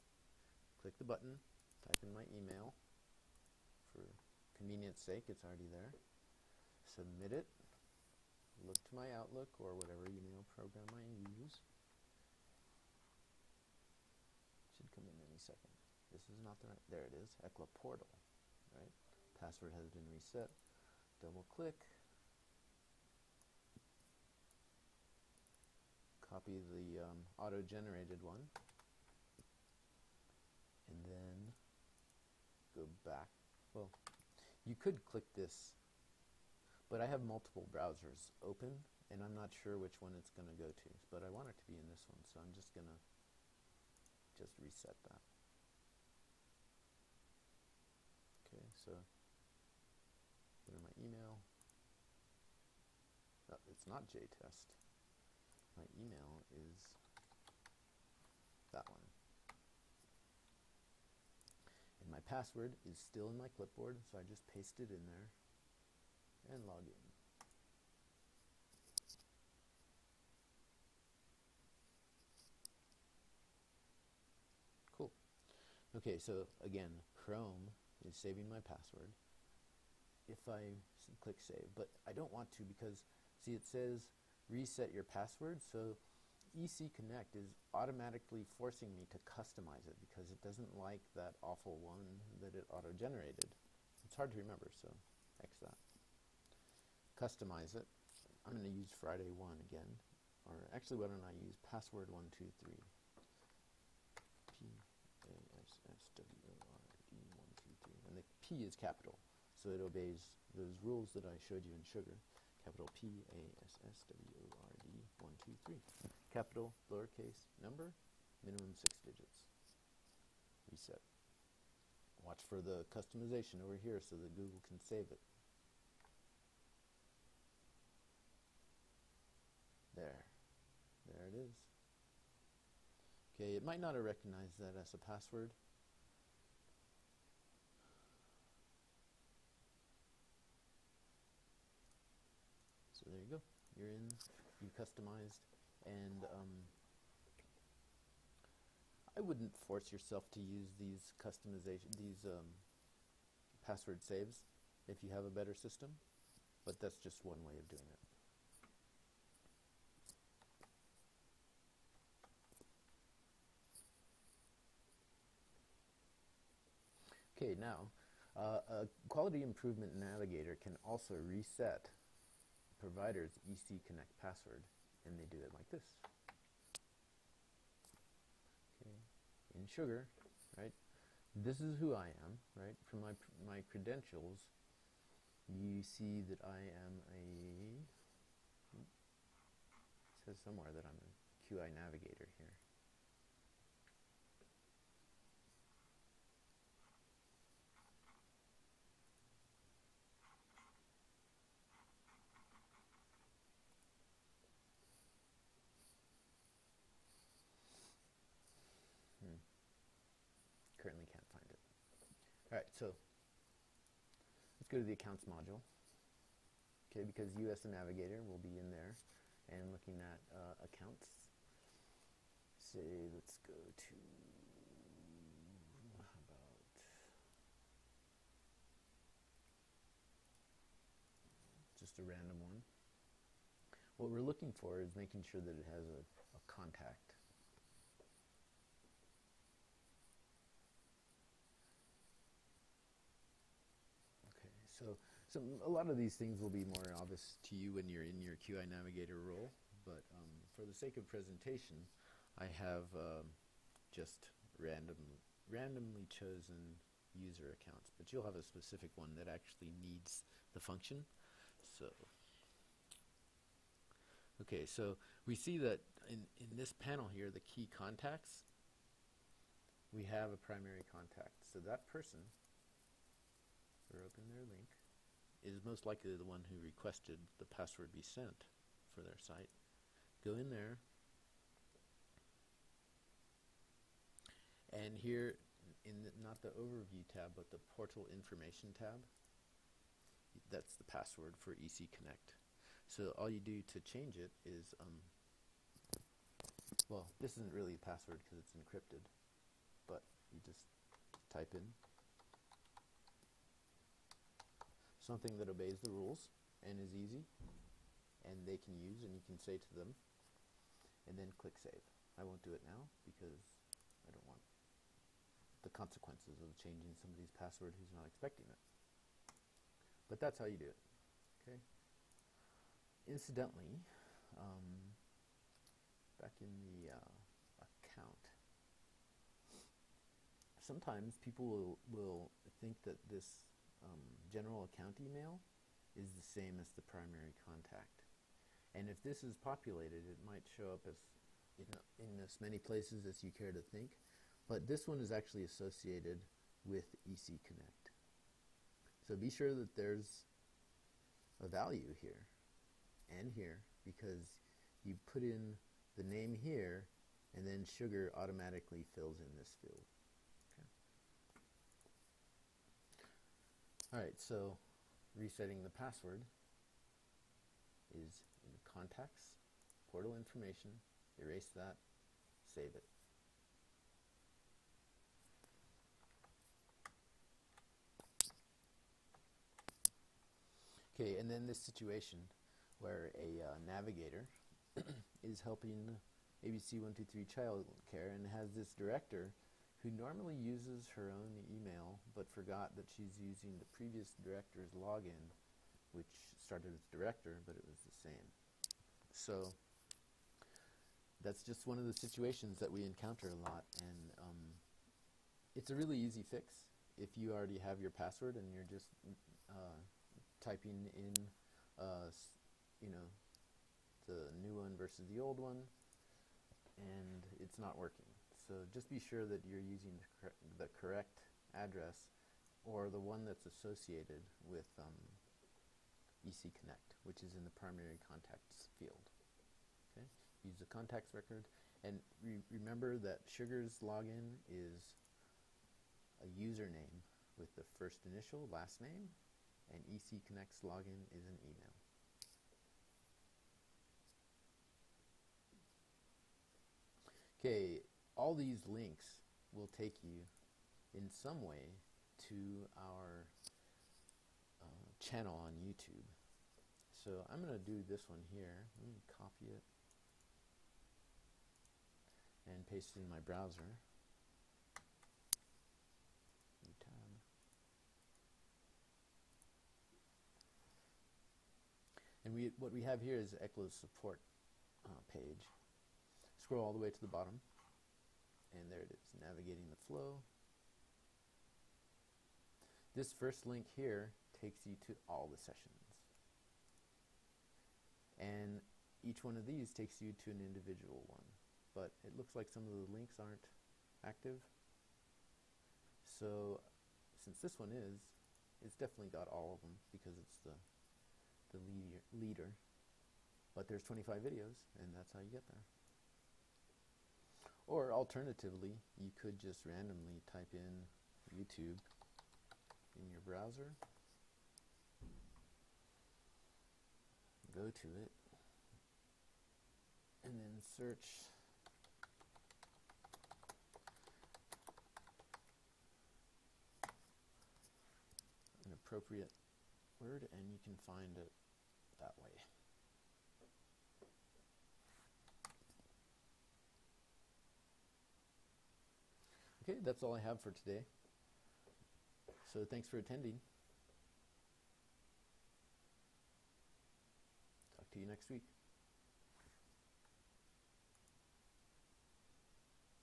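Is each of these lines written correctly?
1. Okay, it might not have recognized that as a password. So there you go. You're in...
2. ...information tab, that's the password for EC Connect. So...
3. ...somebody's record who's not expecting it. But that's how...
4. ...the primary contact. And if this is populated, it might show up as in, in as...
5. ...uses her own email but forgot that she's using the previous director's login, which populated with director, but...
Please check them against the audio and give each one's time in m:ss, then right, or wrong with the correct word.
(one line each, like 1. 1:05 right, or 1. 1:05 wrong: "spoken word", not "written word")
1. 2:13 right
2. 4:48 right
3. 5:17 wrong: "password", not "record"
4. 5:36 right
5. 6:30 wrong: "started", not "populated".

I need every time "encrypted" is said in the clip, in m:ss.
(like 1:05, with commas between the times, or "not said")
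4:58.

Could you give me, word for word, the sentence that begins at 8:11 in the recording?
But it looks like some of the links aren't active.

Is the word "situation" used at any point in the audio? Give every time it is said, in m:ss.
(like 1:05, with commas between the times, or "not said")
6:21, 6:41.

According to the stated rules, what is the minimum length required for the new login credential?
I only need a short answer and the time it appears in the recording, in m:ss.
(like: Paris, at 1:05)
six, at 1:58.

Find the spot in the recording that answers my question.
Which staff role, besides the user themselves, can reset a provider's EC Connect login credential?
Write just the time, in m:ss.
2:49.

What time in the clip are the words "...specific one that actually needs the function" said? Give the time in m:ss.
4:18.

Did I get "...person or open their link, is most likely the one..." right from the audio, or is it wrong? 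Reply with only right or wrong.
right.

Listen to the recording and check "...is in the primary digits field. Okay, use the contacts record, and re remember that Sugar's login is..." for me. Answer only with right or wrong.
wrong.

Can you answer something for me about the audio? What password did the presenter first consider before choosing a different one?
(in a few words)
Friday 1.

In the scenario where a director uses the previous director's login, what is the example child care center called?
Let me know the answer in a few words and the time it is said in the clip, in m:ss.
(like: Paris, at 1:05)
ABC123 child care, at 6:26.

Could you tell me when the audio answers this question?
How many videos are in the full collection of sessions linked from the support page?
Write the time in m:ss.
8:23.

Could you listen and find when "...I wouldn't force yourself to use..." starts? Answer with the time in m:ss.
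2:29.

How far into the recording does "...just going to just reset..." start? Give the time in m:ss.
0:42.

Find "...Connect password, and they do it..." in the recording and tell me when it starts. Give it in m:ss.
2:53.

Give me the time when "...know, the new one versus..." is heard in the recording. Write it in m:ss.
6:52.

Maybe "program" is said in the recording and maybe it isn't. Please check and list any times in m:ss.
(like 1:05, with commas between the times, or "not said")
0:10.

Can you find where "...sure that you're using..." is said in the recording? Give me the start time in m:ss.
6:58.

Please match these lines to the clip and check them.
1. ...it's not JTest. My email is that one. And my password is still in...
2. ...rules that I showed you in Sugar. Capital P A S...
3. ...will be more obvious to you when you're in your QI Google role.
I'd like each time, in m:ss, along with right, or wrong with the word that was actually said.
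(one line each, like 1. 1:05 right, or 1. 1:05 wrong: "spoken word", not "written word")
1. 0:53 right
2. 1:50 right
3. 4:06 wrong: "Navigator", not "Google".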